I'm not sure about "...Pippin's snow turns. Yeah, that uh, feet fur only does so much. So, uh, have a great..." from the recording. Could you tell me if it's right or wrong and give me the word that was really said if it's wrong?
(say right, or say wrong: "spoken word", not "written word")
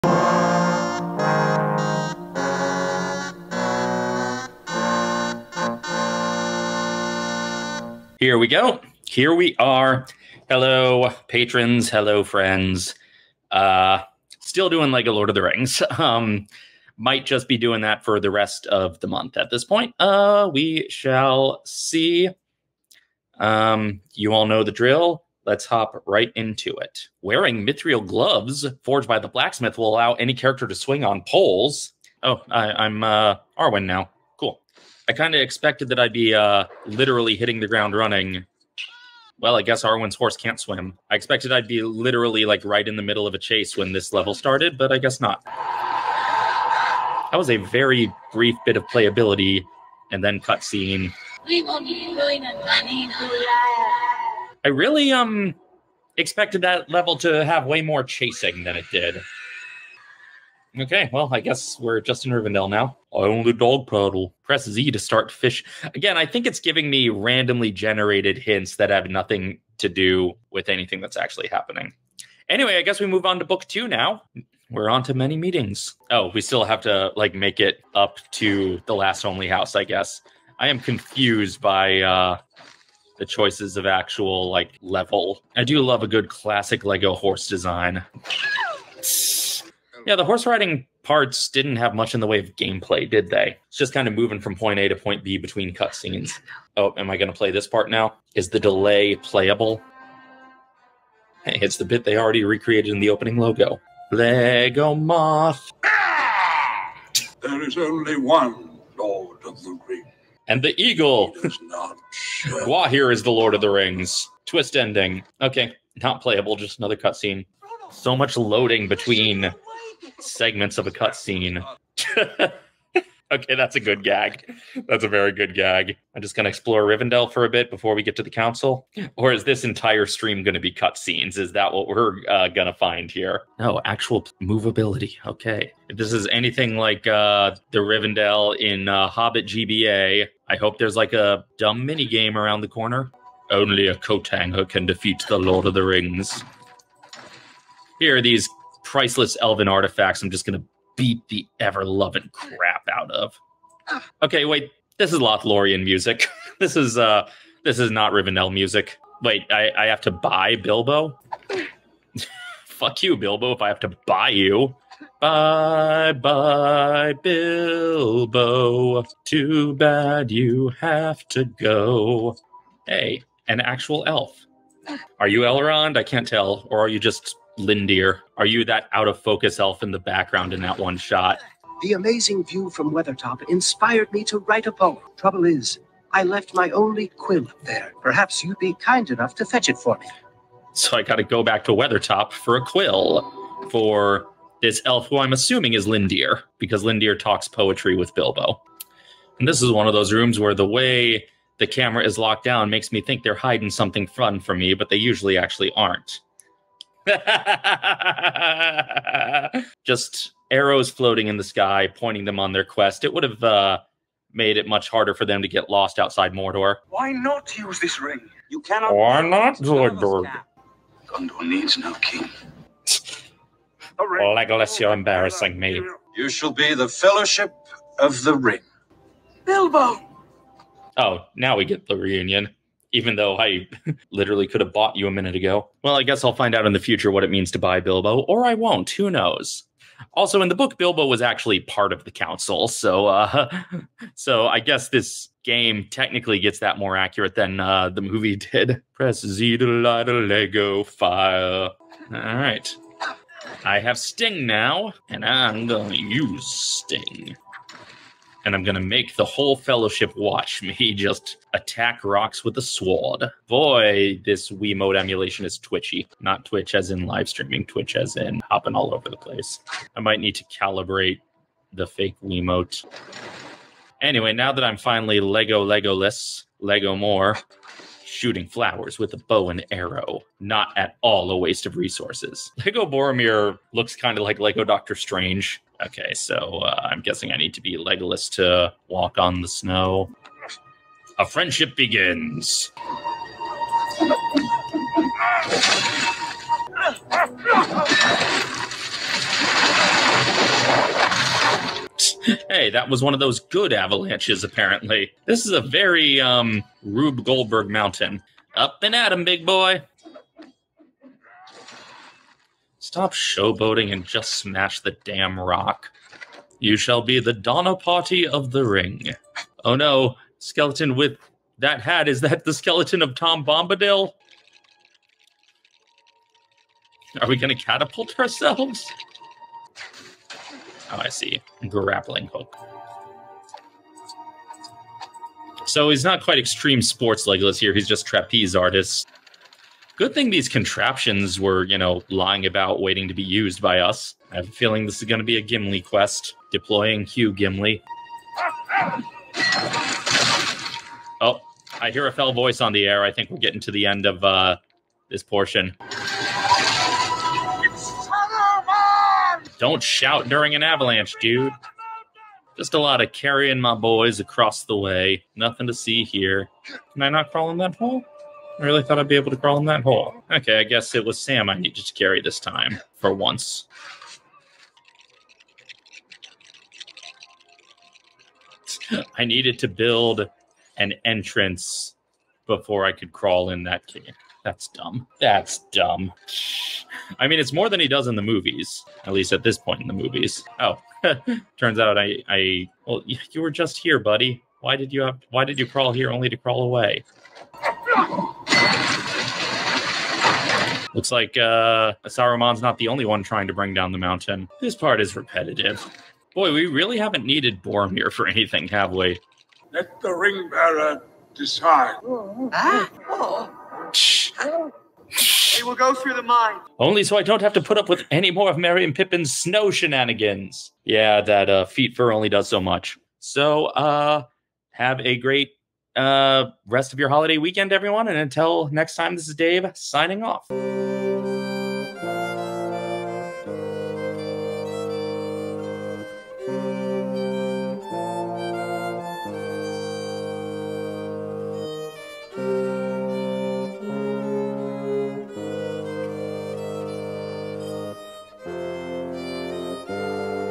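wrong: "shenanigans", not "turns".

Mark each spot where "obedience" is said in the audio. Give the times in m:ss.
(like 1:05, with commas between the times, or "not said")
not said.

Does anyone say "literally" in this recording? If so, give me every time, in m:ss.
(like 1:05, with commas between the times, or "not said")
0:36, 0:41, 3:54.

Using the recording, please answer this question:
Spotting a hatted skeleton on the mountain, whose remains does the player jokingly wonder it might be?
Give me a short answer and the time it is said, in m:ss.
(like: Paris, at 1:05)
Tom Bombadil, at 5:23.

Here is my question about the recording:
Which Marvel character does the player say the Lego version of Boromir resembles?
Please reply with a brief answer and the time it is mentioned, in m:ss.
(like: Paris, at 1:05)
Doctor Strange, at 4:44.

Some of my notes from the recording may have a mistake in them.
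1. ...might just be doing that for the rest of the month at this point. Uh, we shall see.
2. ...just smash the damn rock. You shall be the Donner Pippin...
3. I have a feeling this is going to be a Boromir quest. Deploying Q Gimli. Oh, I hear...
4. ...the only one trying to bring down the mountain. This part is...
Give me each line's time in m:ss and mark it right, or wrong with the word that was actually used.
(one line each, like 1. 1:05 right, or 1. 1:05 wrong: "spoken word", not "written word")
1. 0:16 right
2. 5:14 wrong: "Party", not "Pippin"
3. 5:44 wrong: "Gimli", not "Boromir"
4. 6:42 right.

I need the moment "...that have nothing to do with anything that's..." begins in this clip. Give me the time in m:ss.
1:08.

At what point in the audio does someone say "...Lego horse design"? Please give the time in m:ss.
1:26.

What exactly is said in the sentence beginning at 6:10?
Okay, I guess it was Sam I needed to carry this time, for once.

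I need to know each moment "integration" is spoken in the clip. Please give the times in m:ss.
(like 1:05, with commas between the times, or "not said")
not said.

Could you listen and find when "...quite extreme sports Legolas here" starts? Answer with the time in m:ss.
5:36.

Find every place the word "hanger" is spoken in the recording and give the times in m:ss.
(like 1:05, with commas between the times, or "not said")
2:24.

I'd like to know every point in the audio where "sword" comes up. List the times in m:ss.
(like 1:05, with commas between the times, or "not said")
4:22.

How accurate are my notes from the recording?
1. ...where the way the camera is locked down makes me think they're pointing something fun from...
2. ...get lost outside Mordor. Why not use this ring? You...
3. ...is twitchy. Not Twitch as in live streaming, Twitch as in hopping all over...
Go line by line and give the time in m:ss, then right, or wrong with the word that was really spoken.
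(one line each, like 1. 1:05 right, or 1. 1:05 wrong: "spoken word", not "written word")
1. 3:20 wrong: "hiding", not "pointing"
2. 3:35 right
3. 4:25 right.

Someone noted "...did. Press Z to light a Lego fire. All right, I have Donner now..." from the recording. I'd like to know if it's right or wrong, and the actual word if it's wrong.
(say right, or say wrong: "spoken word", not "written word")
wrong: "Sting", not "Donner".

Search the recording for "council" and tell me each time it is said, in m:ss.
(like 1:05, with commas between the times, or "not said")
2:08, 4:02.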